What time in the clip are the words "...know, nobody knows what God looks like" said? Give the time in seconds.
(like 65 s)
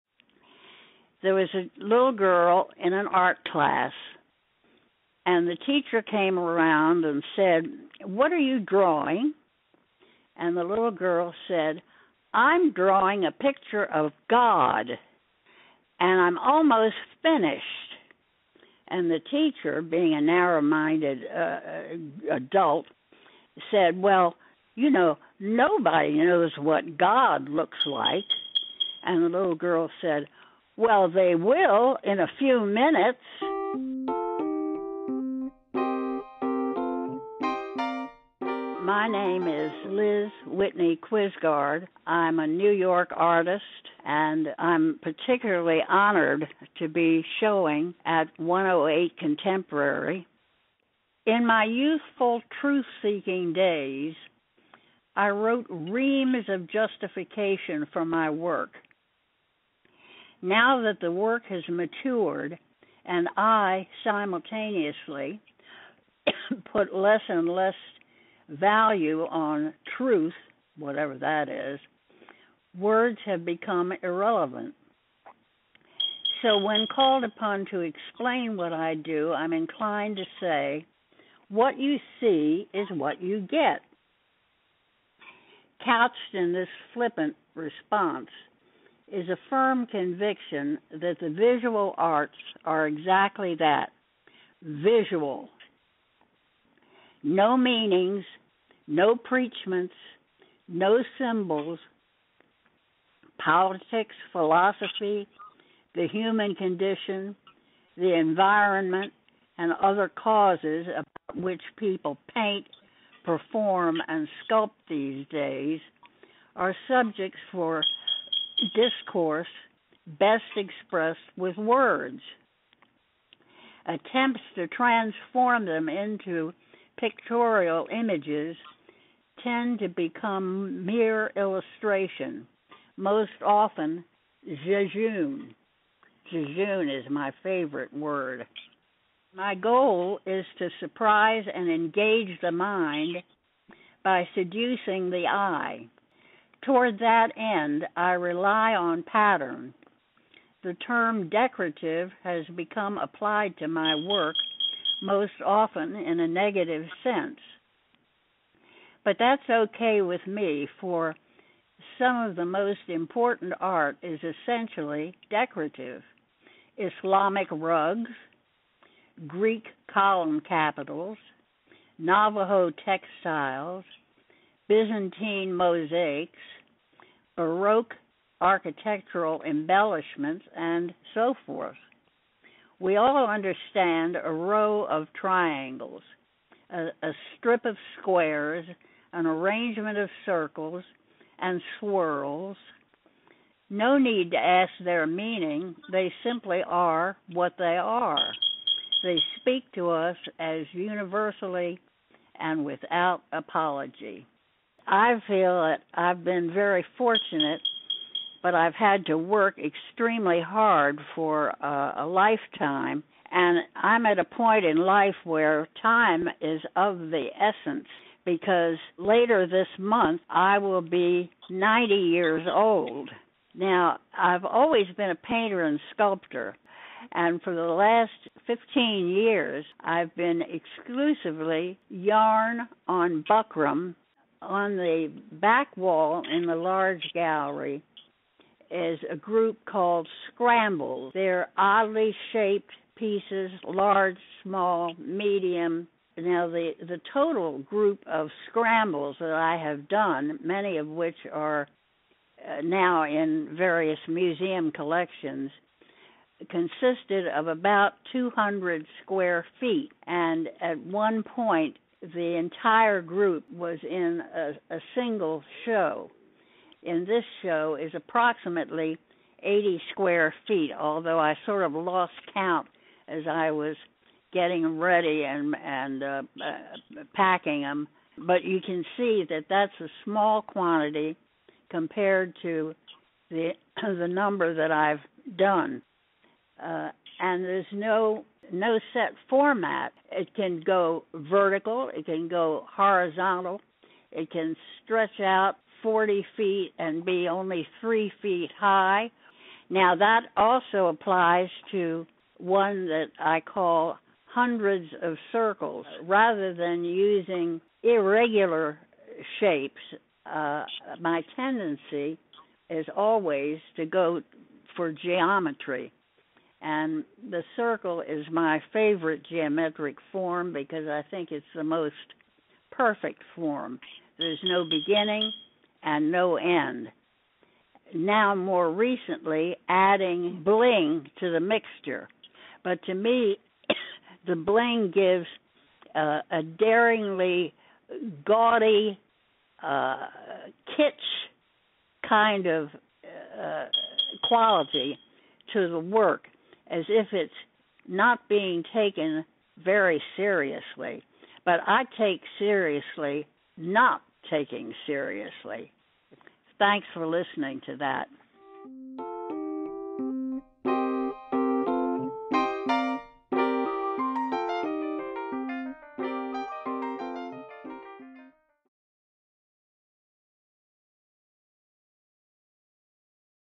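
24 s.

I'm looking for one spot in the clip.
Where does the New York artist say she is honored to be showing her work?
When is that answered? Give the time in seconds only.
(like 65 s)
48 s.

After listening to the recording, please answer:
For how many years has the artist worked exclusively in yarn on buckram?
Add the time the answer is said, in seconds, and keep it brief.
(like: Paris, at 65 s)
15, at 228 s.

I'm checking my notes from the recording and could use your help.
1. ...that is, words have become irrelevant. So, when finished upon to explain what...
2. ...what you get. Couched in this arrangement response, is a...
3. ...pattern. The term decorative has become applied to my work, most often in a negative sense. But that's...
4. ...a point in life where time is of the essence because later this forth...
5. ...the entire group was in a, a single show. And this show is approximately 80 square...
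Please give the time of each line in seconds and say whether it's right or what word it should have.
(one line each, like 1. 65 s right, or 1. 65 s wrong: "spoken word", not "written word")
1. 71 s wrong: "called", not "finished"
2. 82 s wrong: "flippant", not "arrangement"
3. 149 s right
4. 214 s wrong: "month", not "forth"
5. 262 s right.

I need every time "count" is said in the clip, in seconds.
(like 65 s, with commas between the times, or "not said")
272 s.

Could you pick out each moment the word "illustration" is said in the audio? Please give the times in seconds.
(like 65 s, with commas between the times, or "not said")
131 s.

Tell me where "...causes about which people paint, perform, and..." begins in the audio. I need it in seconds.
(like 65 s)
110 s.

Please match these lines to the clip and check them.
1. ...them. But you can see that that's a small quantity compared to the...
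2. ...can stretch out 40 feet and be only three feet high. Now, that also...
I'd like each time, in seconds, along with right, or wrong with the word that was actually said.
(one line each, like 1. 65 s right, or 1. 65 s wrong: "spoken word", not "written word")
1. 277 s right
2. 294 s right.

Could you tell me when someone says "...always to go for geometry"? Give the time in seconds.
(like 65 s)
312 s.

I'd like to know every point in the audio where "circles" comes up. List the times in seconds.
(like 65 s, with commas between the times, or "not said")
190 s, 305 s, 317 s.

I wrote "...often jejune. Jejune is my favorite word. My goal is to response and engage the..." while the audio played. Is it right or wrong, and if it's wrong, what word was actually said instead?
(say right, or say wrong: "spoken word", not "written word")
wrong: "surprise", not "response".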